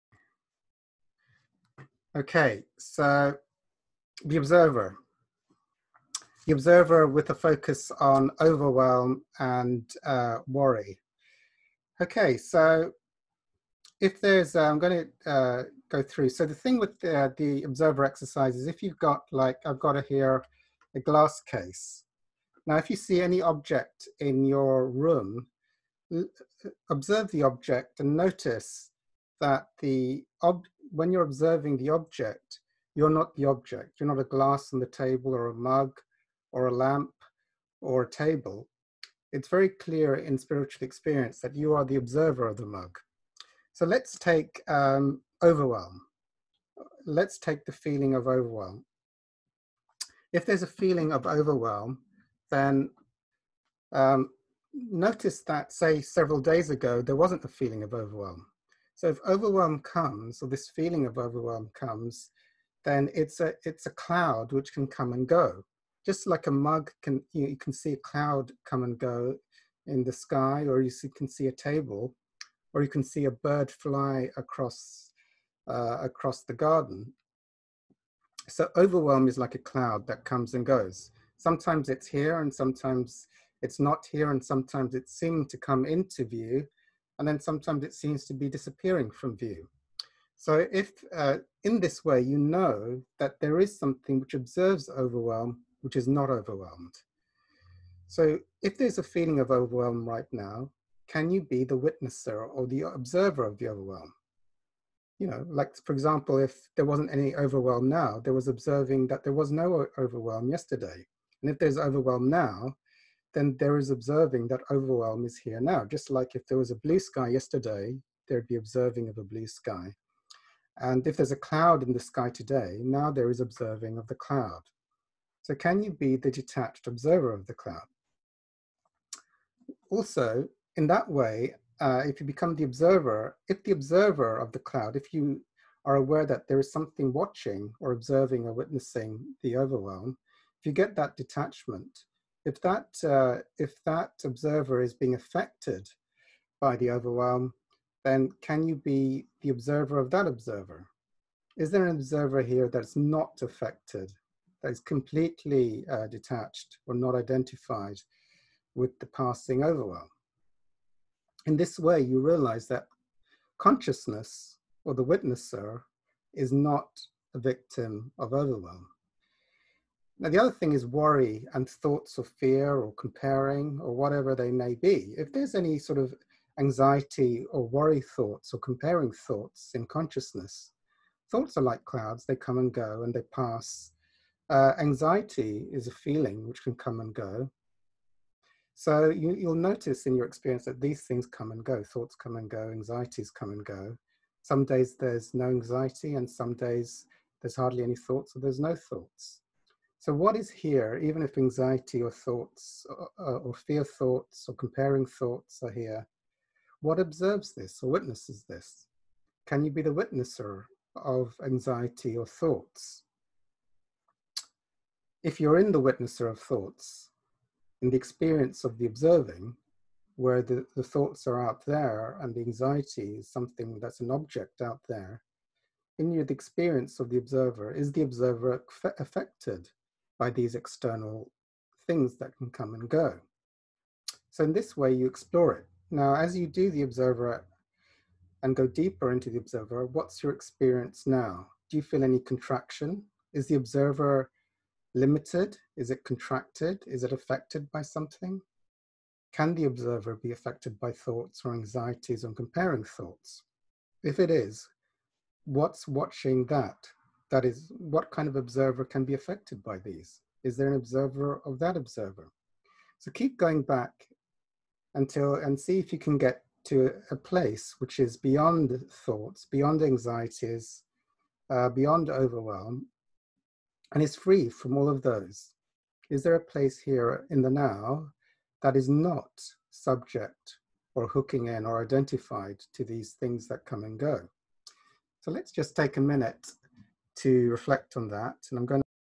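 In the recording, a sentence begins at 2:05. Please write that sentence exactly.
So can you be the detached observer of the cloud?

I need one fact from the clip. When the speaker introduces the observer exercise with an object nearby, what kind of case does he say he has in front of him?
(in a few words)
glass case.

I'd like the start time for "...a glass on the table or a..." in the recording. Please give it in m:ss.
0:34.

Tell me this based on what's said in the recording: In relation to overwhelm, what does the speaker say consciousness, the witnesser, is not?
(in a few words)
a victim.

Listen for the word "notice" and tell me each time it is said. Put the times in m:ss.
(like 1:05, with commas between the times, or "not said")
0:28, 0:54, 3:09.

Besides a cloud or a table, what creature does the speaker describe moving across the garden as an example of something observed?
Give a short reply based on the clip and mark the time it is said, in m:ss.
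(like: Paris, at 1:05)
bird, at 1:13.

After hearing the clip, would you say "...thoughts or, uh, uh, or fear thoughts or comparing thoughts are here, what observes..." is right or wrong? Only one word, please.
right.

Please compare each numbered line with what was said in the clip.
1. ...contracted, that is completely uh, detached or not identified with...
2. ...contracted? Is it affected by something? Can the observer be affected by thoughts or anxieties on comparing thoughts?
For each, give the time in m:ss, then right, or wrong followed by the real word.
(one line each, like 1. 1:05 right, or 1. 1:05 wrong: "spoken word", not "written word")
1. 2:33 wrong: "affected", not "contracted"
2. 4:06 right.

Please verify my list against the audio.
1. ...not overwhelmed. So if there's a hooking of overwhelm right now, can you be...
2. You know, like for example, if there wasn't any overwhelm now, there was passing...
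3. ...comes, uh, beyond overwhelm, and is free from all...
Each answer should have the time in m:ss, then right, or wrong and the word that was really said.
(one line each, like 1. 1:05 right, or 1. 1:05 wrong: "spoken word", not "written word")
1. 1:36 wrong: "feeling", not "hooking"
2. 1:45 wrong: "observing", not "passing"
3. 4:29 wrong: "anxieties", not "comes".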